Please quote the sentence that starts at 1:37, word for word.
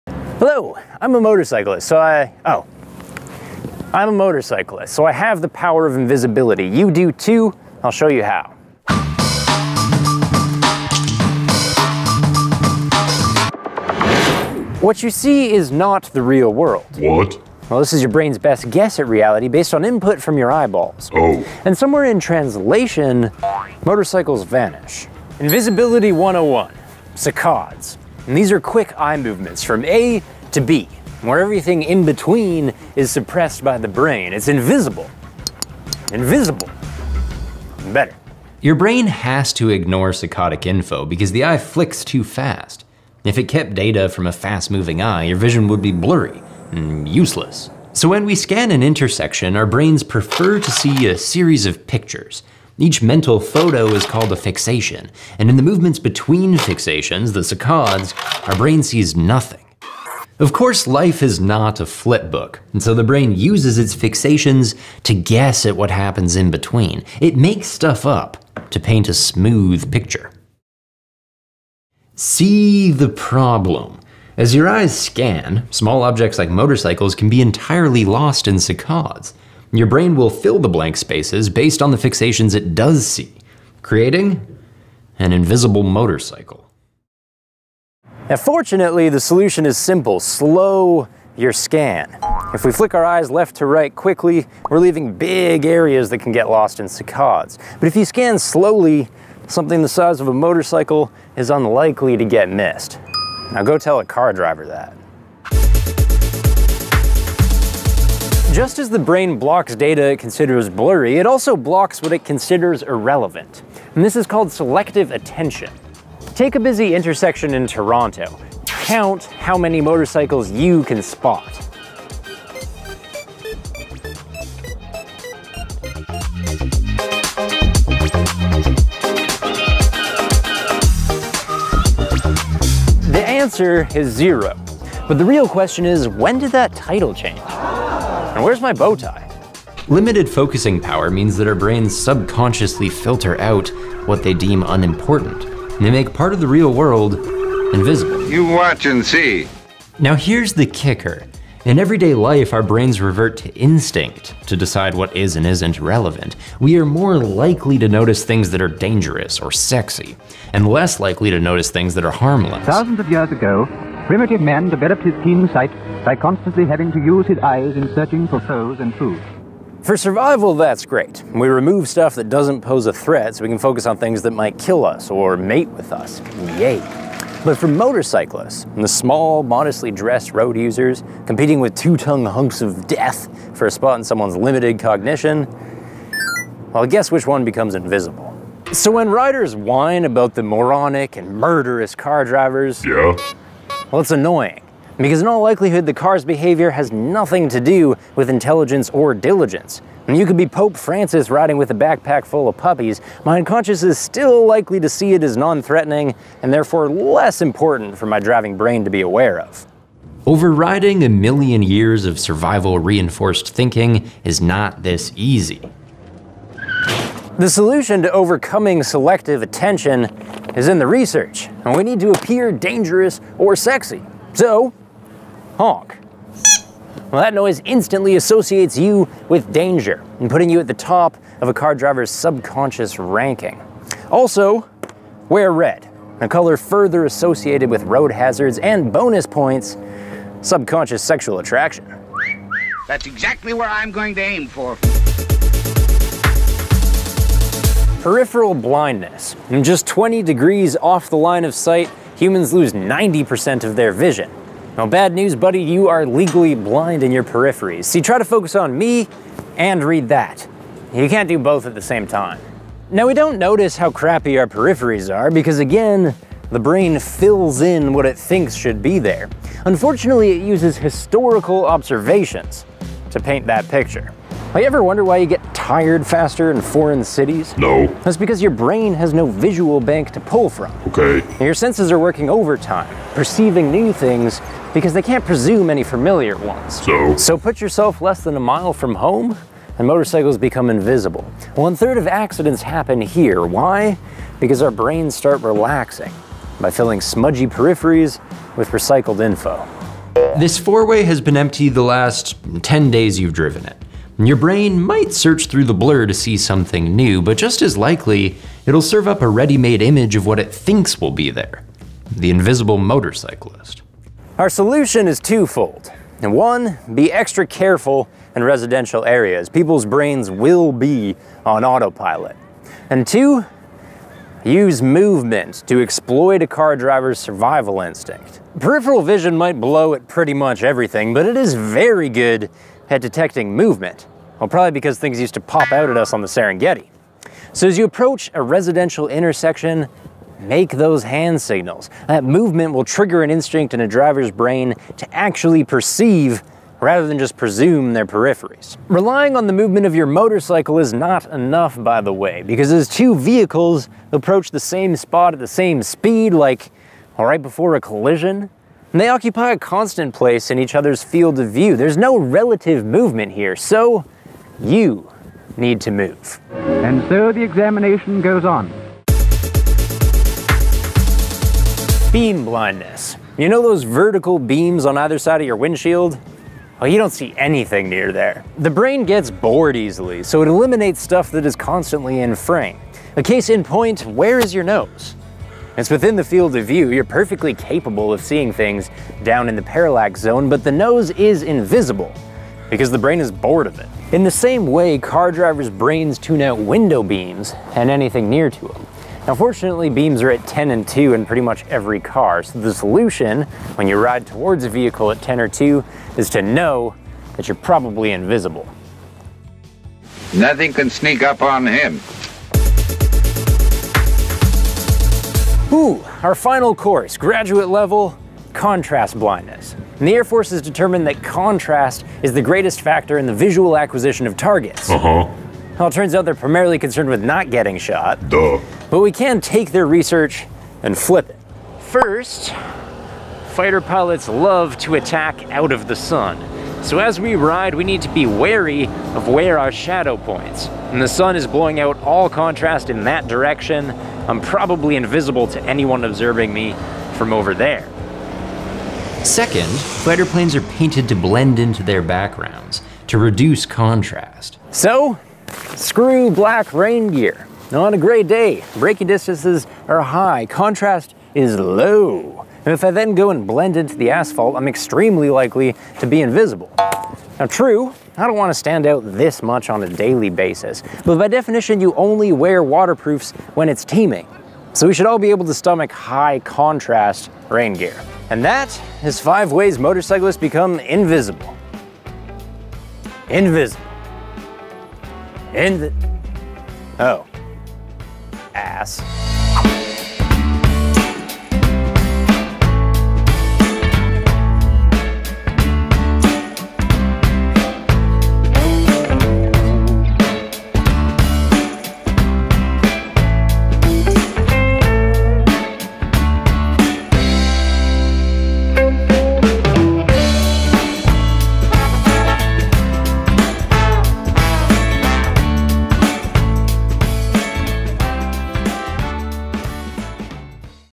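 But if you scan slowly, something the size of a motorcycle is unlikely to get missed.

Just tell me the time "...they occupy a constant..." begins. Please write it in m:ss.
5:58.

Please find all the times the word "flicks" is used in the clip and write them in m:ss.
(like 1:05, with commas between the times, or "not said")
0:41, 1:32.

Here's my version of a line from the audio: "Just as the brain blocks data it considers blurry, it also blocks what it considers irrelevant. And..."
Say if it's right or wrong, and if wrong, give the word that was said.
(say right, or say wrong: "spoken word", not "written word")
right.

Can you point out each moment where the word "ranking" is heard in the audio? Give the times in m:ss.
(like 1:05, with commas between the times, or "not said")
3:52.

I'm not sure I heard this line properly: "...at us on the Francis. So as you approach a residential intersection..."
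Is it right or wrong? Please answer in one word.
wrong.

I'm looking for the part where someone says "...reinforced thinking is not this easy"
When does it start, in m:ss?
3:32.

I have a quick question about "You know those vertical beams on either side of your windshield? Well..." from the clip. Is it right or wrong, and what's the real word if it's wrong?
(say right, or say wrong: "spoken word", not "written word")
right.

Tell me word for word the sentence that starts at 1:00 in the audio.
Of course, life is not a flip book, and so the brain uses its fixations to guess at what happens in between.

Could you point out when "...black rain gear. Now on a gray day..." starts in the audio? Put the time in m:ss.
7:36.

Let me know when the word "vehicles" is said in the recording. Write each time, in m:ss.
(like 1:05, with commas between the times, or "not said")
5:53, 6:44.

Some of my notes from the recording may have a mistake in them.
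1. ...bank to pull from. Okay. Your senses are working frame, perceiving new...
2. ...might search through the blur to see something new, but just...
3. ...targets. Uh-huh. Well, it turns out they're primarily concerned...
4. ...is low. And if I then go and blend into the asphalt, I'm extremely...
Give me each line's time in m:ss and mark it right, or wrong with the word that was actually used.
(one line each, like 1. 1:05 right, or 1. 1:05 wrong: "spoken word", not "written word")
1. 4:39 wrong: "overtime", not "frame"
2. 5:04 right
3. 7:04 right
4. 7:41 right.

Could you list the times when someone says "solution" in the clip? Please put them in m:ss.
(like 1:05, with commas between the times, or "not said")
1:29, 3:37, 5:14, 6:42.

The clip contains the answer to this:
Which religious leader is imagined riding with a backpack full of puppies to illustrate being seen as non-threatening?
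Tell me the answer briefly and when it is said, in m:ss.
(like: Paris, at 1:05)
Pope Francis, at 3:20.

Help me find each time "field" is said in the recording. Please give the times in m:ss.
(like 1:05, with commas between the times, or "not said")
6:01, 6:26.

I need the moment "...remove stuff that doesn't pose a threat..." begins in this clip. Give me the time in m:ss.
2:51.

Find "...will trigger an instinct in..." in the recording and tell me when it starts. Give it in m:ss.
5:42.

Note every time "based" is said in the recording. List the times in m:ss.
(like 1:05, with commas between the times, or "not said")
0:19, 1:21.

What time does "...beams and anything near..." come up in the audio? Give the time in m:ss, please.
6:37.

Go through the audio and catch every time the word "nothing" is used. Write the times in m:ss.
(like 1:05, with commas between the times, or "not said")
0:59, 3:16, 6:50.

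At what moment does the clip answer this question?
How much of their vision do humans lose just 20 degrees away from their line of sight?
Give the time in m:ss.
4:12.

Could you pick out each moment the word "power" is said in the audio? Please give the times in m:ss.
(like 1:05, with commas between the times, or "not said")
0:05, 2:20.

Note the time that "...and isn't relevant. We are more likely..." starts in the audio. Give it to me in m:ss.
2:35.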